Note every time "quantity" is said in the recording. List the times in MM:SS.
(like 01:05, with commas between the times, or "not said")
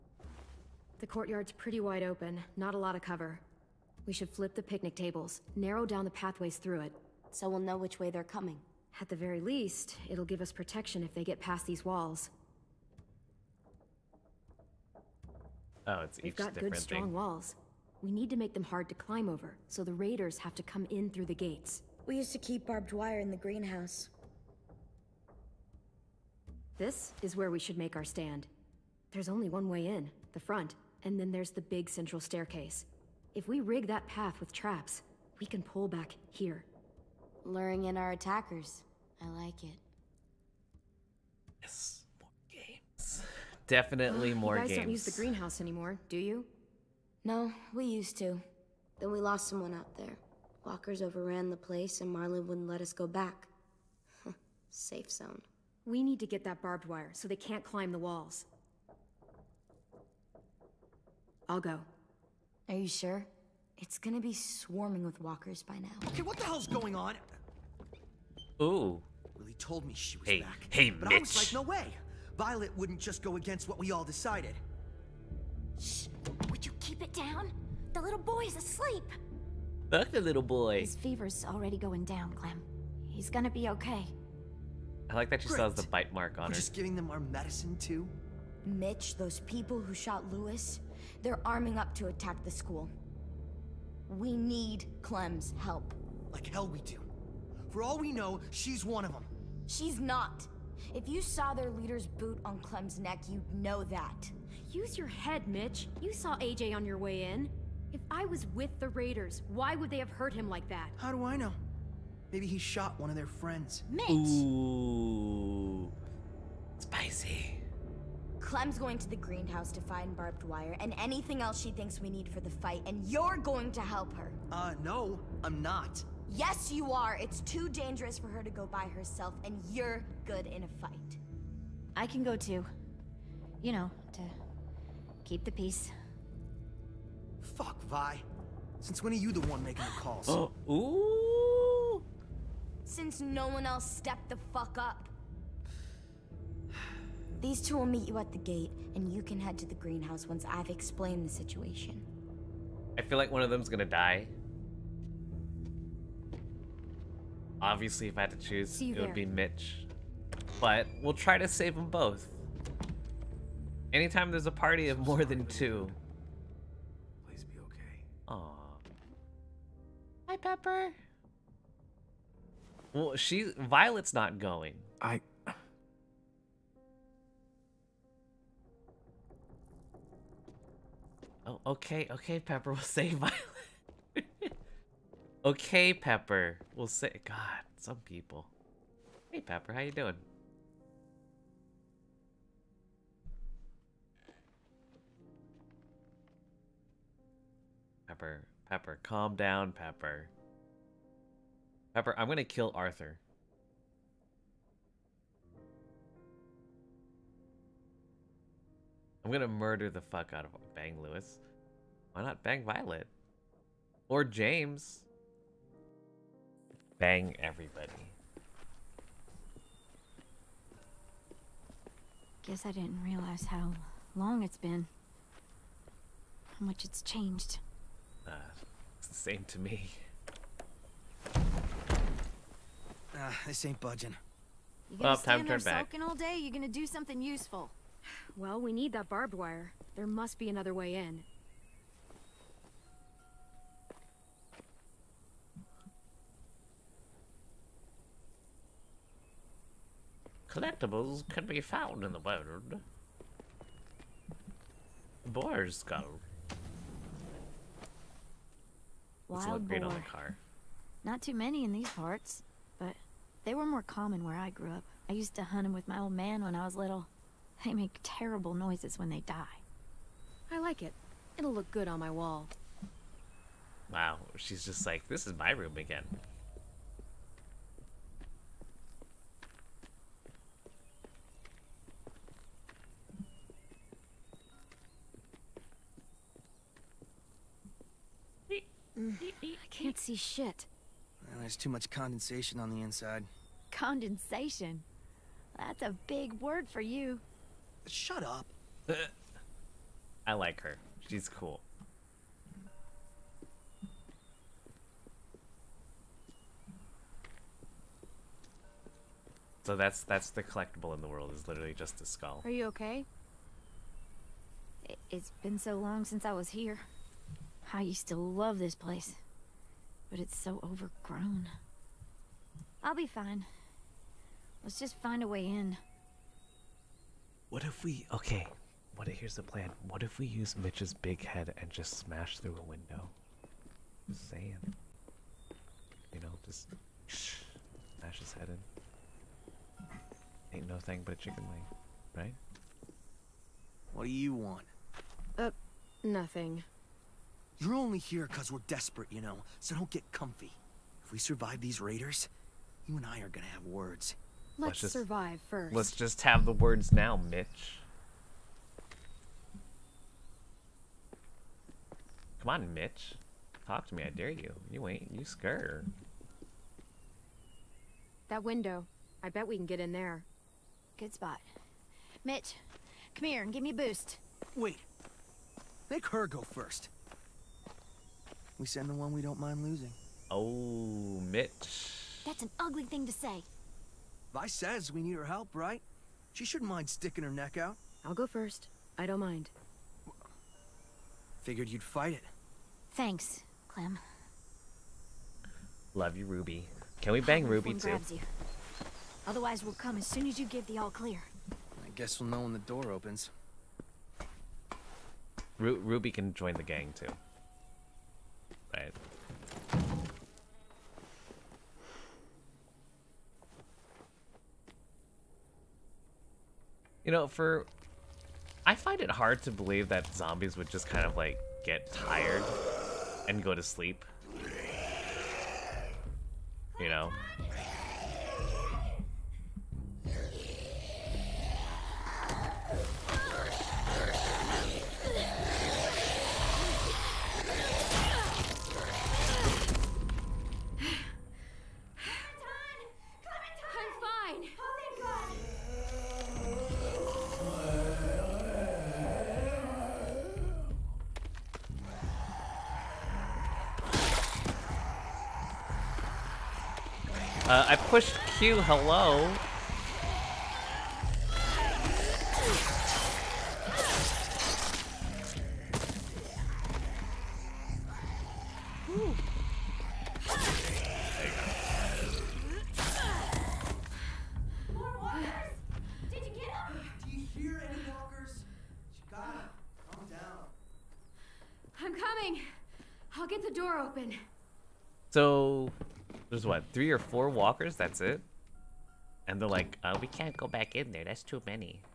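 not said.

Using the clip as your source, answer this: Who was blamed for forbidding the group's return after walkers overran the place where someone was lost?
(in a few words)
Marlon.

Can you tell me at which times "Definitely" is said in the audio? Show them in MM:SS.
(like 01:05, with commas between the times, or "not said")
00:43.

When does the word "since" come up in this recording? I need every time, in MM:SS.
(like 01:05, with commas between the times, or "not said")
02:18, 02:22, 05:16.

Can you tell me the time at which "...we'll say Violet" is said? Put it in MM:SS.
03:02.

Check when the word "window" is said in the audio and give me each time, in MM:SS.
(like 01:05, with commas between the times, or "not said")
05:32, 06:08.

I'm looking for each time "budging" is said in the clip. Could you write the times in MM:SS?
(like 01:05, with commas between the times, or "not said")
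03:53.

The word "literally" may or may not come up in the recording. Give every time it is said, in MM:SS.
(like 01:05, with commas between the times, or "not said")
05:11.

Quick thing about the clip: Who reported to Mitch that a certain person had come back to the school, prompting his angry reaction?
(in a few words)
Lilly.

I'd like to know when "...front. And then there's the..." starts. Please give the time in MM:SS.
00:30.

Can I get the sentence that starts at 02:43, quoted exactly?
Anytime there's a party of more than two.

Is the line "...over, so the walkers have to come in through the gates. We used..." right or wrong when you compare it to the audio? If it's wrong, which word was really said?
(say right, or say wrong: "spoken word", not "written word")
wrong: "raiders", not "walkers".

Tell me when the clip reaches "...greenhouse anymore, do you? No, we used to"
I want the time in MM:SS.
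00:45.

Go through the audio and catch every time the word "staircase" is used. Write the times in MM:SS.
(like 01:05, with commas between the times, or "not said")
00:32.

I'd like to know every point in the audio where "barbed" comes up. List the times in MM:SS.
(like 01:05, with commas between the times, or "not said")
00:22, 00:56, 02:00, 03:59.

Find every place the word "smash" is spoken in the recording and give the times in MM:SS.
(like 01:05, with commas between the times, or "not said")
05:31, 05:37.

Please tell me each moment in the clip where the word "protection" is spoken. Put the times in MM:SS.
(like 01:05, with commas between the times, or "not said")
00:10.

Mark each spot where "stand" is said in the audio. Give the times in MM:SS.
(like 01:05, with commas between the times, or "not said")
00:28, 03:55.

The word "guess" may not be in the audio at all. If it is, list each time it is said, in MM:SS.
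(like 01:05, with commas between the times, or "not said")
03:42, 06:41.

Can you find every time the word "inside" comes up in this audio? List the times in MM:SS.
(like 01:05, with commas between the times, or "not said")
04:52.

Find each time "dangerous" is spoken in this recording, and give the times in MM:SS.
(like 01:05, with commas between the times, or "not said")
02:07.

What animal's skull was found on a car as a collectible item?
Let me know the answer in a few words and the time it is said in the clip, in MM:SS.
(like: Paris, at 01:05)
Wild boar, at 04:19.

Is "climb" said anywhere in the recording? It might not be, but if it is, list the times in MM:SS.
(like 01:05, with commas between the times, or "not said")
00:18, 00:57.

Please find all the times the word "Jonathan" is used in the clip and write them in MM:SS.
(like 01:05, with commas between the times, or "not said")
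not said.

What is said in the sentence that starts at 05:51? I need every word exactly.
If we survive these raiders, you and I are gonna have words.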